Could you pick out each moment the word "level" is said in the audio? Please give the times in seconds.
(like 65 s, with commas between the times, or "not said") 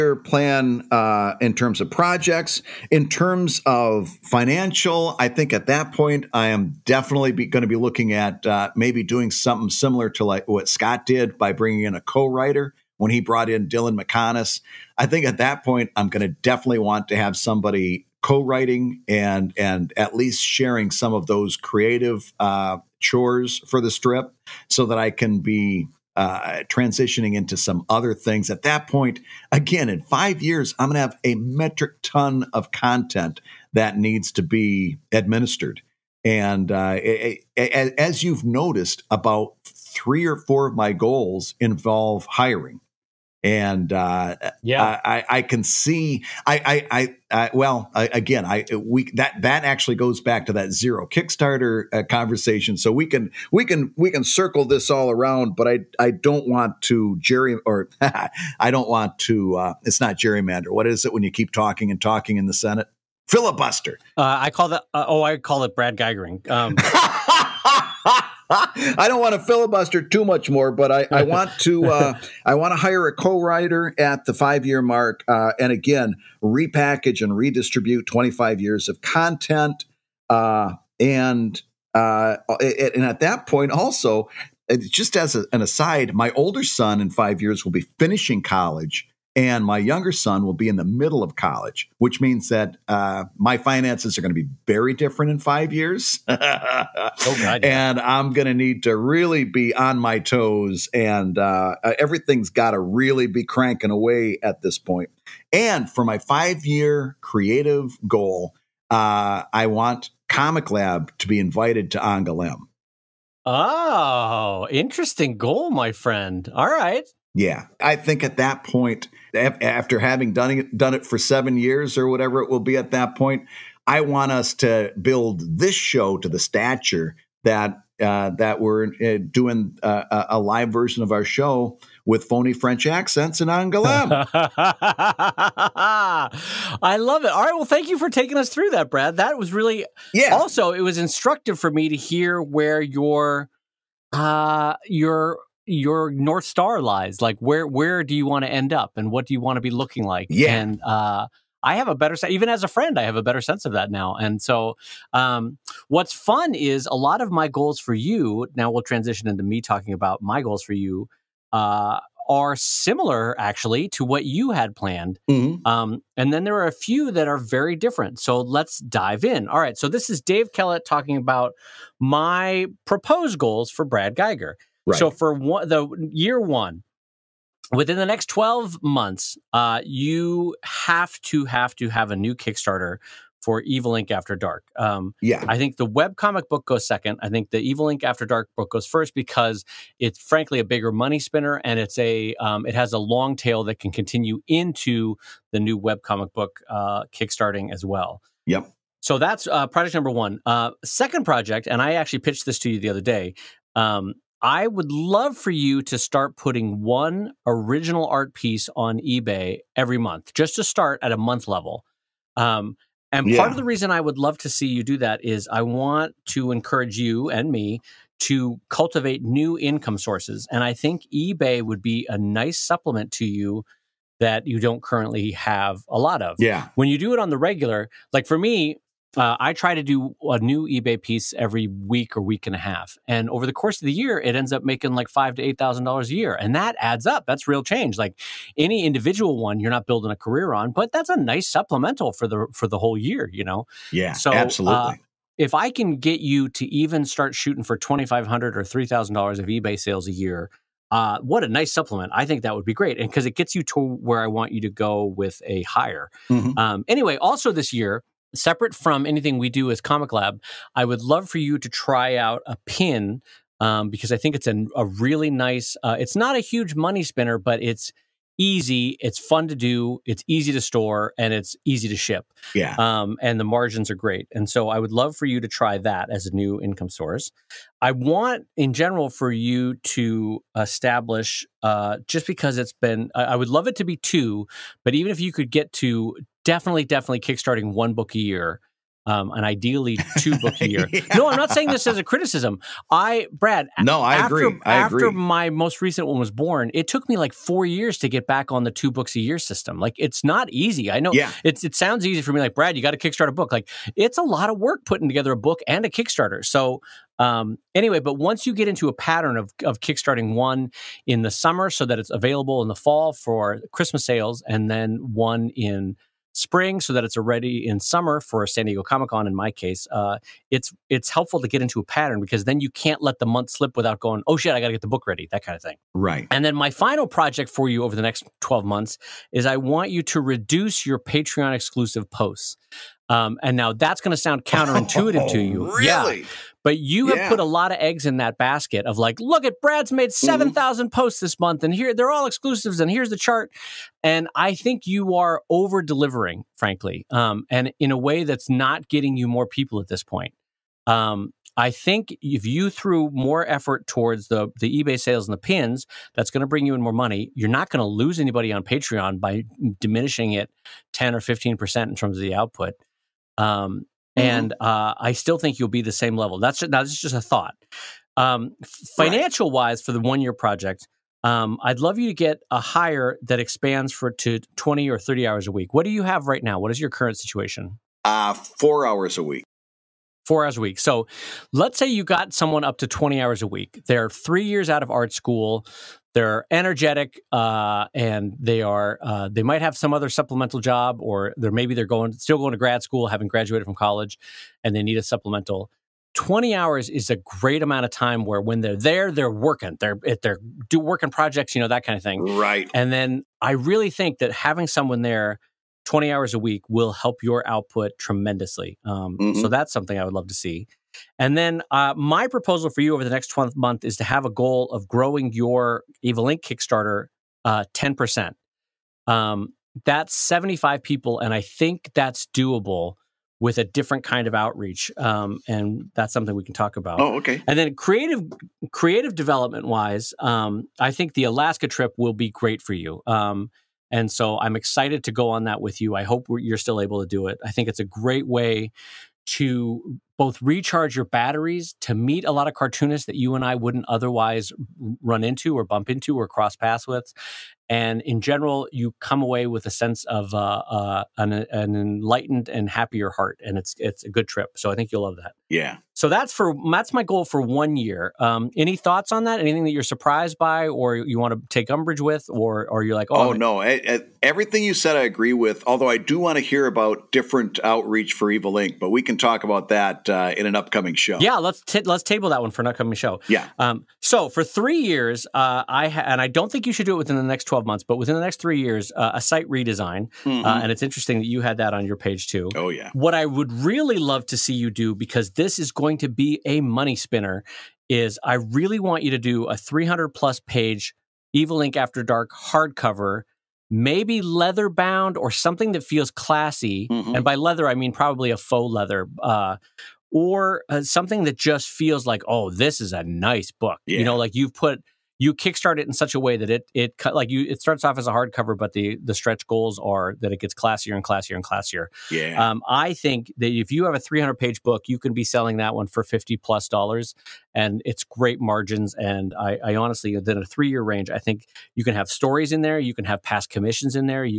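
211 s, 366 s.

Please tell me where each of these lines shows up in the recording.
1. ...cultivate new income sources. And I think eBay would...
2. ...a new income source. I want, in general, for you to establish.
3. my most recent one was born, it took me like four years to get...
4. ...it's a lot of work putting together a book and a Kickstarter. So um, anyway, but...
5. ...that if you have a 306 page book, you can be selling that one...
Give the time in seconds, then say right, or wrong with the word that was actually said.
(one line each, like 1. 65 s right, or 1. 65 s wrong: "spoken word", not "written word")
1. 218 s right
2. 276 s right
3. 295 s right
4. 303 s right
5. 513 s wrong: "300", not "306".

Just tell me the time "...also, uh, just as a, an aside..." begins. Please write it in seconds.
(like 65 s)
83 s.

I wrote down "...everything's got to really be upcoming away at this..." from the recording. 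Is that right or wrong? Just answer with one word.
wrong.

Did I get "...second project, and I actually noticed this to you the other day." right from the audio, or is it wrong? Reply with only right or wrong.
wrong.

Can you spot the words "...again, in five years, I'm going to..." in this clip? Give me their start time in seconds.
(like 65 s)
29 s.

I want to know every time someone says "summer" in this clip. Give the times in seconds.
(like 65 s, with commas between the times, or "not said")
311 s, 317 s.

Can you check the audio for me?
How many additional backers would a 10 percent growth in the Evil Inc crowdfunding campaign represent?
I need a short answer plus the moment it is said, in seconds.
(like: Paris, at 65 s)
75, at 420 s.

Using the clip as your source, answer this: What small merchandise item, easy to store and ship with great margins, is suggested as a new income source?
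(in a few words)
A pin.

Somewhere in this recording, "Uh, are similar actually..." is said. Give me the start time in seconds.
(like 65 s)
161 s.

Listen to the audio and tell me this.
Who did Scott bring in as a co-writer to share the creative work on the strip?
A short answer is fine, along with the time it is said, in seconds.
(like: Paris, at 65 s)
Dylan Meconis, at 13 s.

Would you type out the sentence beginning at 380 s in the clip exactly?
So let's say you got someone up to 20 hours a week.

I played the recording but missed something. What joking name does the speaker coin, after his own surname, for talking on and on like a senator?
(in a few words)
Brad Guigaring.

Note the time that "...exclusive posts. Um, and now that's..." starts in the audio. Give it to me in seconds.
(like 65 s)
331 s.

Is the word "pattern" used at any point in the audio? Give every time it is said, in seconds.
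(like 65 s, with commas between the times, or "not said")
308 s, 321 s.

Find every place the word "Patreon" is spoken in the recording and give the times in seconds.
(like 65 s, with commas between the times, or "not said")
330 s, 358 s.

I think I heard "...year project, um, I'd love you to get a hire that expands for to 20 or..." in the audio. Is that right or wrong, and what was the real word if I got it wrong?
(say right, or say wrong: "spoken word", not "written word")
right.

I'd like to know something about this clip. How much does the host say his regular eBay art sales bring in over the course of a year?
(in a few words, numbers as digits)
5,000 to 8,000 dollars.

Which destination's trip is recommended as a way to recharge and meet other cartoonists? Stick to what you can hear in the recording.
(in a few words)
Alaska.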